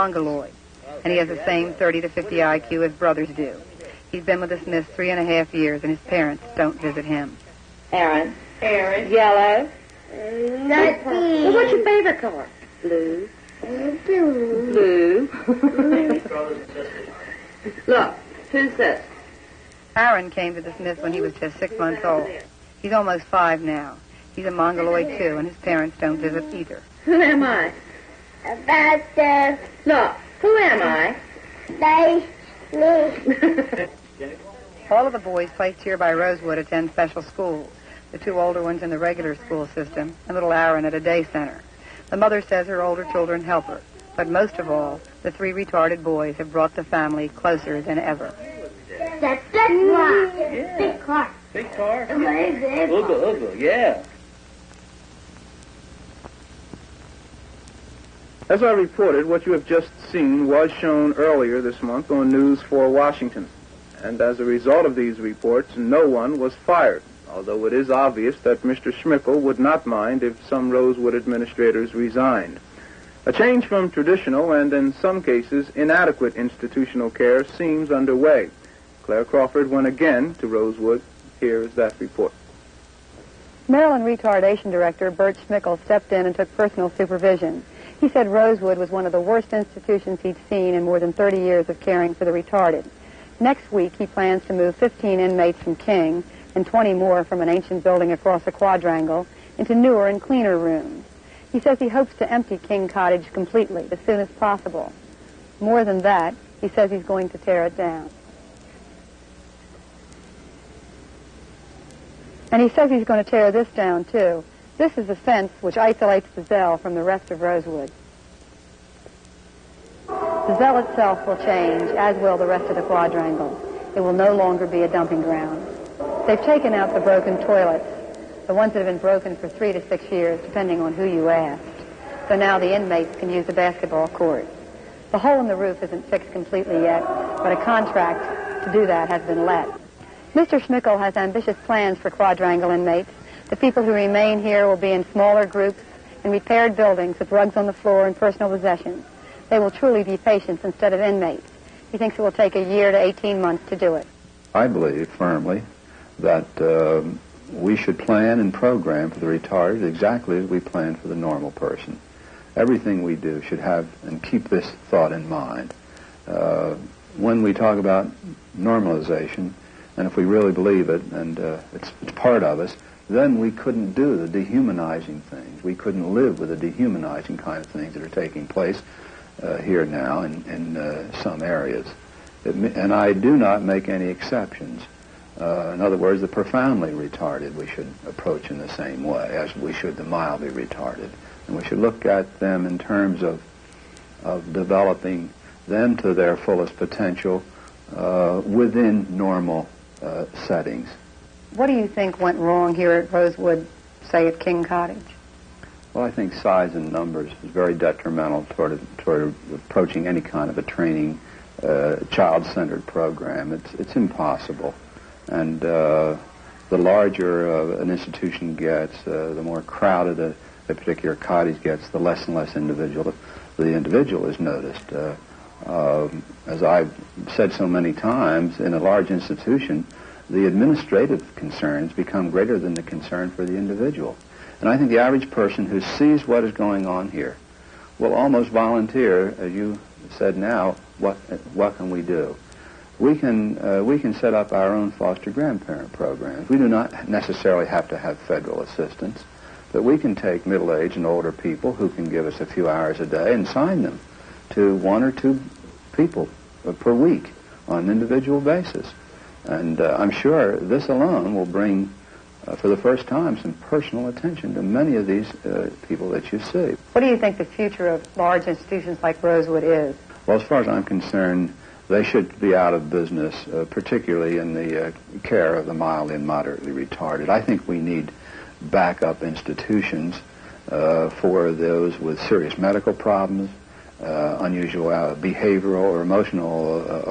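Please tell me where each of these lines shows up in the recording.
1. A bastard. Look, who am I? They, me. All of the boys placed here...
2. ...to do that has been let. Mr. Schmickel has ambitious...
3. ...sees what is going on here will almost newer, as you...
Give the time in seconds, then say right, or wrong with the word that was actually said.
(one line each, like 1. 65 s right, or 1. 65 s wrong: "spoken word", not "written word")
1. 28 s right
2. 138 s right
3. 235 s wrong: "volunteer", not "newer".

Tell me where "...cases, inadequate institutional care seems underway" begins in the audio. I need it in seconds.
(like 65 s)
75 s.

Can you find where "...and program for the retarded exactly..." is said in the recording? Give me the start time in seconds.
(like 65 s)
158 s.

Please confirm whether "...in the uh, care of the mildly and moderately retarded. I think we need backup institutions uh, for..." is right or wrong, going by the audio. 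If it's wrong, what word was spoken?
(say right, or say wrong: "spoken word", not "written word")
right.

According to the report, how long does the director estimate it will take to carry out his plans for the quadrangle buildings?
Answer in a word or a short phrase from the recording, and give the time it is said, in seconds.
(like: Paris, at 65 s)
a year to 18 months, at 152 s.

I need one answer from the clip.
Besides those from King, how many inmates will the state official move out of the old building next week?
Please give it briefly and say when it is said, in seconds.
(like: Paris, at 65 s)
20, at 96 s.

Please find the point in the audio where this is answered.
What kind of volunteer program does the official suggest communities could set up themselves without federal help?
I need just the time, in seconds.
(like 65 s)
244 s.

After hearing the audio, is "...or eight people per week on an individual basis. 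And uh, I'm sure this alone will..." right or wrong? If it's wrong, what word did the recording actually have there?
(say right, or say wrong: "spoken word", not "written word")
wrong: "two", not "eight".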